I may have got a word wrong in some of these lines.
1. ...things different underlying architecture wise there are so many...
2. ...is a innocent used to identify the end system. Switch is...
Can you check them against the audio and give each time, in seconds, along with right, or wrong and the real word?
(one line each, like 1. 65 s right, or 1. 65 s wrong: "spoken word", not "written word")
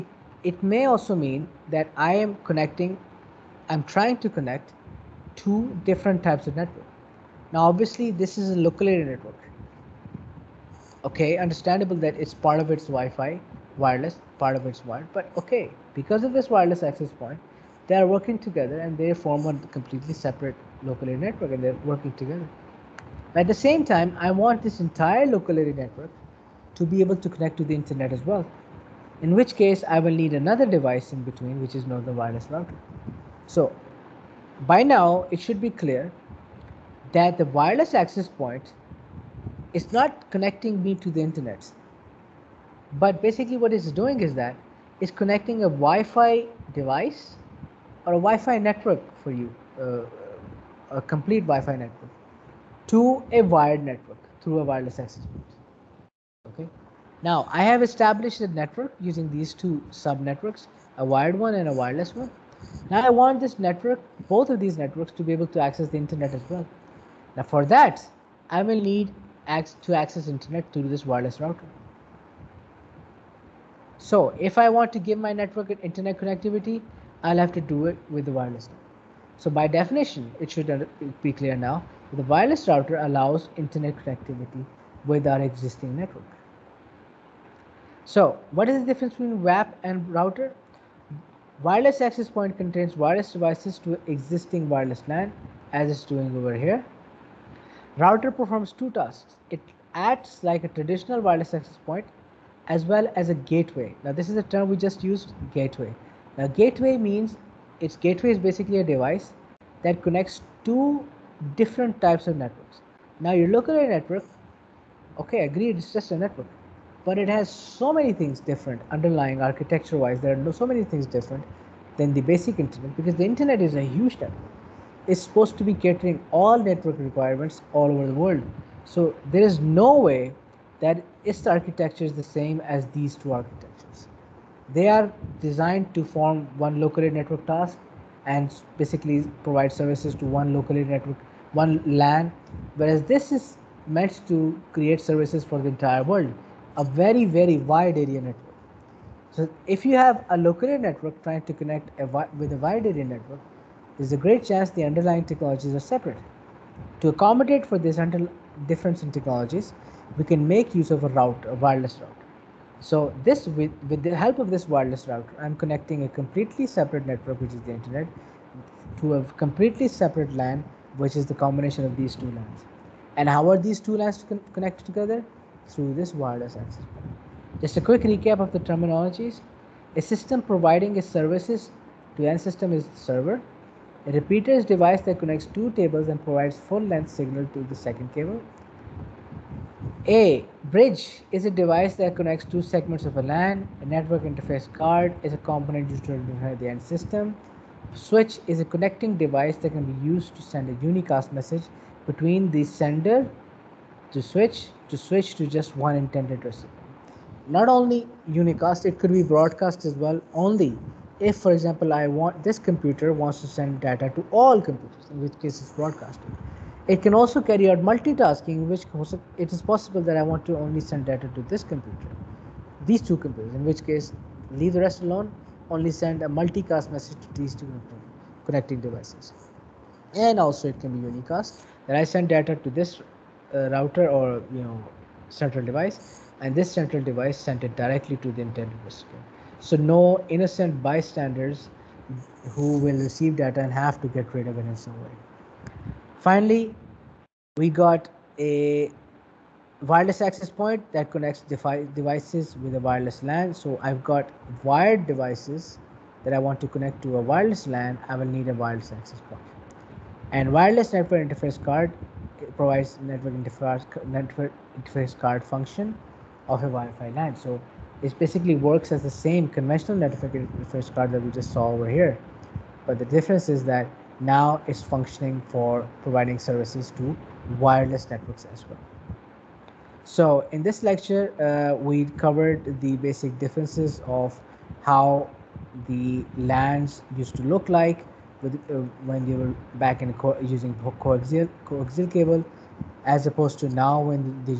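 1. 118 s right
2. 195 s wrong: "component", not "innocent".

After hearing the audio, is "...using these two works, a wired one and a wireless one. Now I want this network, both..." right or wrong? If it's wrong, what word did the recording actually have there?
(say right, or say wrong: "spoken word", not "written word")
wrong: "subnetworks", not "works".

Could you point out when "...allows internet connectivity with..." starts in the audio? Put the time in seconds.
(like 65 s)
82 s.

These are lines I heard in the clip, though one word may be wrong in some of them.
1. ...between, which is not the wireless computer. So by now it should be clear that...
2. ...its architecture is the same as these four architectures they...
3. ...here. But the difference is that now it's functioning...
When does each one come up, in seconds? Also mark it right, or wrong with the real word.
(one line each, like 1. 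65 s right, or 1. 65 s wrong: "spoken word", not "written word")
1. 31 s wrong: "router", not "computer"
2. 131 s wrong: "two", not "four"
3. 271 s right.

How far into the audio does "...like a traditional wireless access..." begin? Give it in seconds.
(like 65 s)
100 s.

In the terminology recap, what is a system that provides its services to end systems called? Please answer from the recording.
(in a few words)
Server.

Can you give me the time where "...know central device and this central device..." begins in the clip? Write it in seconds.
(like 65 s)
234 s.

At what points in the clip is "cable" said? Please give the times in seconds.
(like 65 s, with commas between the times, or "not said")
188 s, 292 s.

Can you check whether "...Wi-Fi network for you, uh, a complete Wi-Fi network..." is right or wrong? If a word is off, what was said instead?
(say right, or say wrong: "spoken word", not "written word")
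right.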